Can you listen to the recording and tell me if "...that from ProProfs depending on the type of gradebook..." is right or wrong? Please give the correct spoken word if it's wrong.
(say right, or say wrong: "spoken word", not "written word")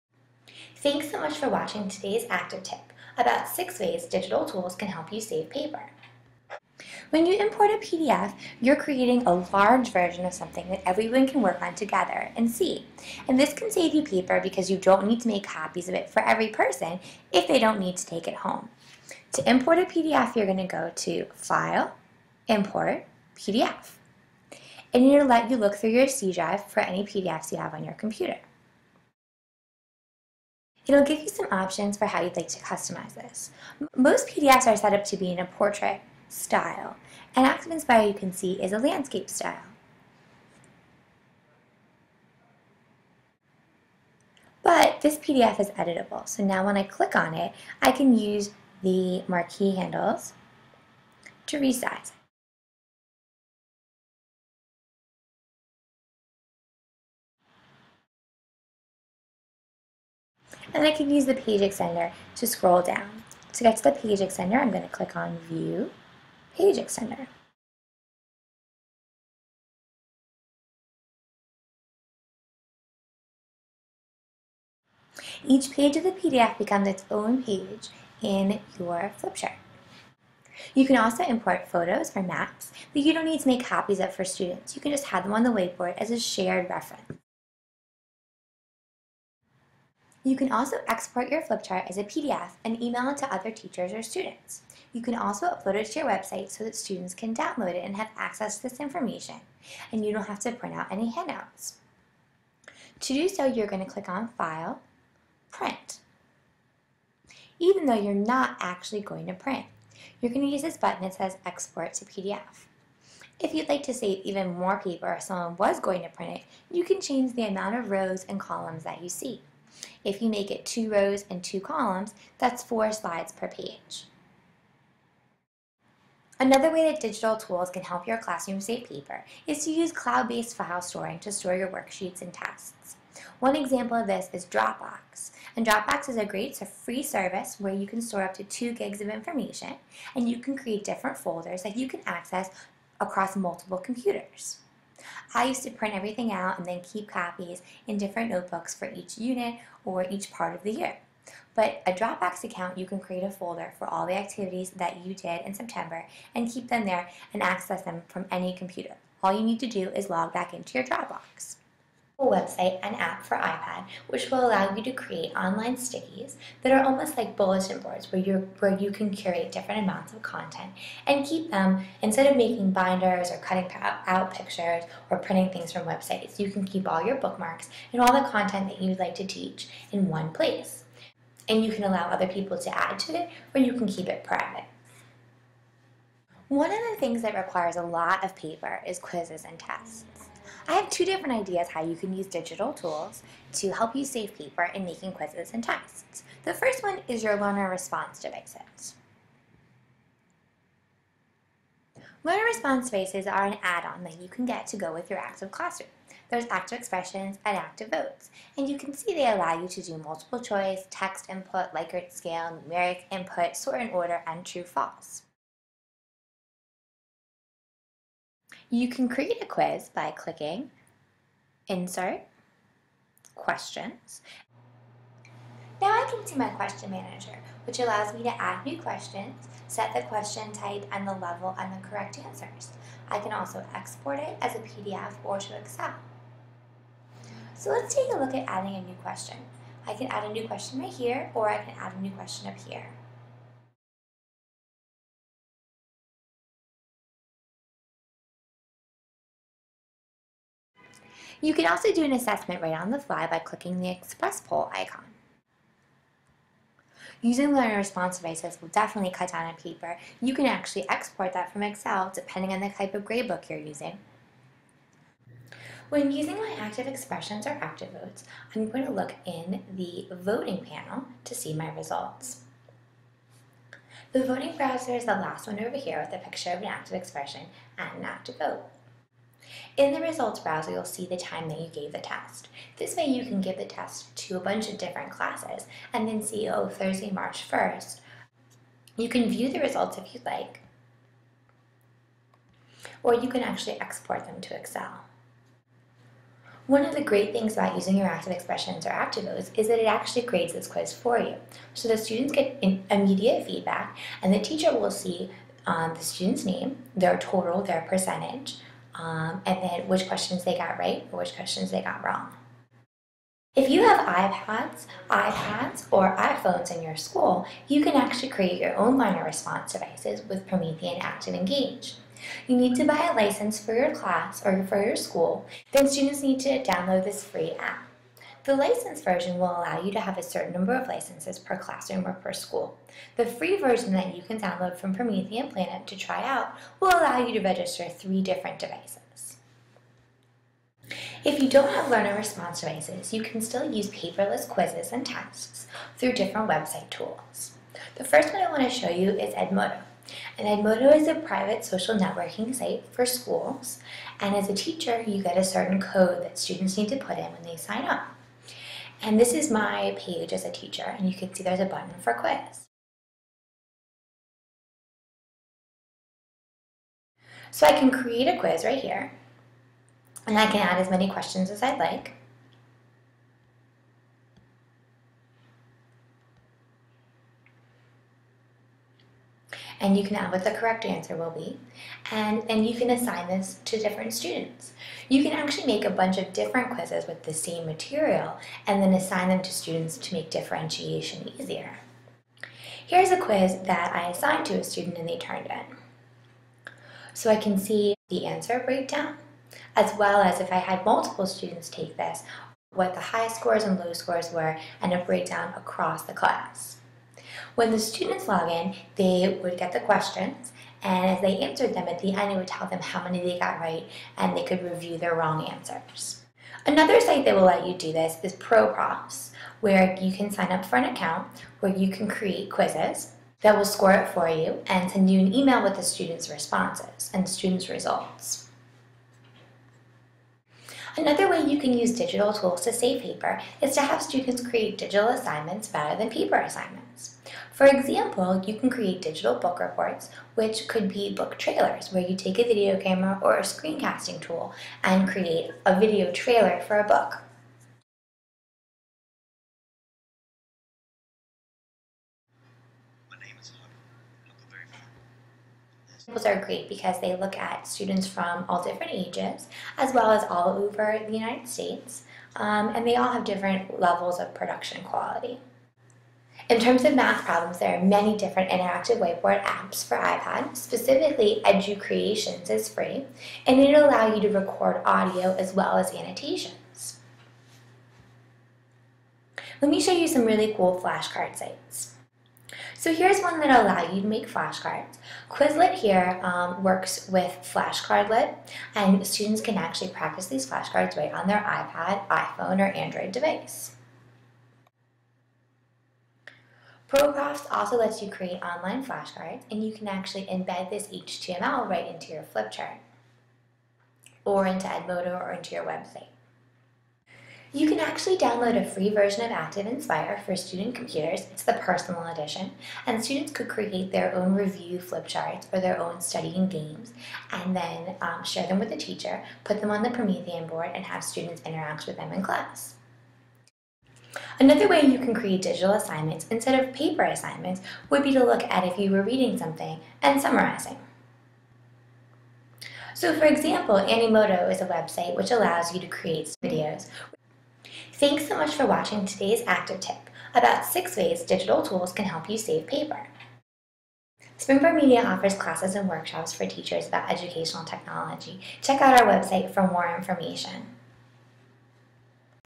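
wrong: "Excel", not "ProProfs".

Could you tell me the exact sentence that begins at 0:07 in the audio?
When you import a PDF, you're creating a large version of something that everyone can work on together and see.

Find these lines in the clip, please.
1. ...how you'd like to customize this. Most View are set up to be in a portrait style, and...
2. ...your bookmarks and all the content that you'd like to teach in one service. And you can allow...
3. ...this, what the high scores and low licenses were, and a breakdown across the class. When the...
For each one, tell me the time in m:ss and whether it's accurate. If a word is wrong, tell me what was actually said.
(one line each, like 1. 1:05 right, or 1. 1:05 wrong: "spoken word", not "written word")
1. 0:32 wrong: "PDFs", not "View"
2. 2:57 wrong: "place", not "service"
3. 6:41 wrong: "scores", not "licenses".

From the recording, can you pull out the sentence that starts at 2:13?
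One example of this is Dropbox.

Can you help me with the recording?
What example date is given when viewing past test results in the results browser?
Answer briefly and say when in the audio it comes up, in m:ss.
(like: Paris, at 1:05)
Thursday, March 1st, at 4:46.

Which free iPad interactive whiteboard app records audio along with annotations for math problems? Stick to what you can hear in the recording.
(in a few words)
EduCreations.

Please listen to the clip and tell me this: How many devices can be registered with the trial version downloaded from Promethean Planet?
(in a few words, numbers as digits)
3.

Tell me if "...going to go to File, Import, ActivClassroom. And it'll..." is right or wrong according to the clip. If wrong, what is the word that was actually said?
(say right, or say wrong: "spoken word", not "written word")
wrong: "PDF", not "ActivClassroom".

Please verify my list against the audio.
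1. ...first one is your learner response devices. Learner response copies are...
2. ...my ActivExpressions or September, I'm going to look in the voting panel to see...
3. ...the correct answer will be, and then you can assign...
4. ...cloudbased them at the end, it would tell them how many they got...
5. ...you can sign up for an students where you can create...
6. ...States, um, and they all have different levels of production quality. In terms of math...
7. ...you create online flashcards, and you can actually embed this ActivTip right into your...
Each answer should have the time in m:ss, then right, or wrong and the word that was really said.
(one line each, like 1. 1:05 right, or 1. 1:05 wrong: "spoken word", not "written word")
1. 3:16 wrong: "devices", not "copies"
2. 4:26 wrong: "ActiVotes", not "September"
3. 6:20 right
4. 6:51 wrong: "answered", not "cloudbased"
5. 6:59 wrong: "account", not "students"
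6. 7:41 right
7. 8:18 wrong: "HTML", not "ActivTip".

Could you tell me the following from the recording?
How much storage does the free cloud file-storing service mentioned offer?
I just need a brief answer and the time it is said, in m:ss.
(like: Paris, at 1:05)
2 gigs, at 2:18.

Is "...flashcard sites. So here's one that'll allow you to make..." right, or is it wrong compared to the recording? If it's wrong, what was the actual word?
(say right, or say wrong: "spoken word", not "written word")
right.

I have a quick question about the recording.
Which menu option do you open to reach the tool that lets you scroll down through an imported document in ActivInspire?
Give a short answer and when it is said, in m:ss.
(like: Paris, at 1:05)
View, Page Extender, at 1:05.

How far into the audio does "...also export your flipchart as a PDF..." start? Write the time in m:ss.
1:30.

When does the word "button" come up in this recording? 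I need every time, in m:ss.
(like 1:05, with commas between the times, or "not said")
1:50, 6:01.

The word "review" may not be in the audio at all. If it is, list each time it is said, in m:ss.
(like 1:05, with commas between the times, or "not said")
6:54, 8:34.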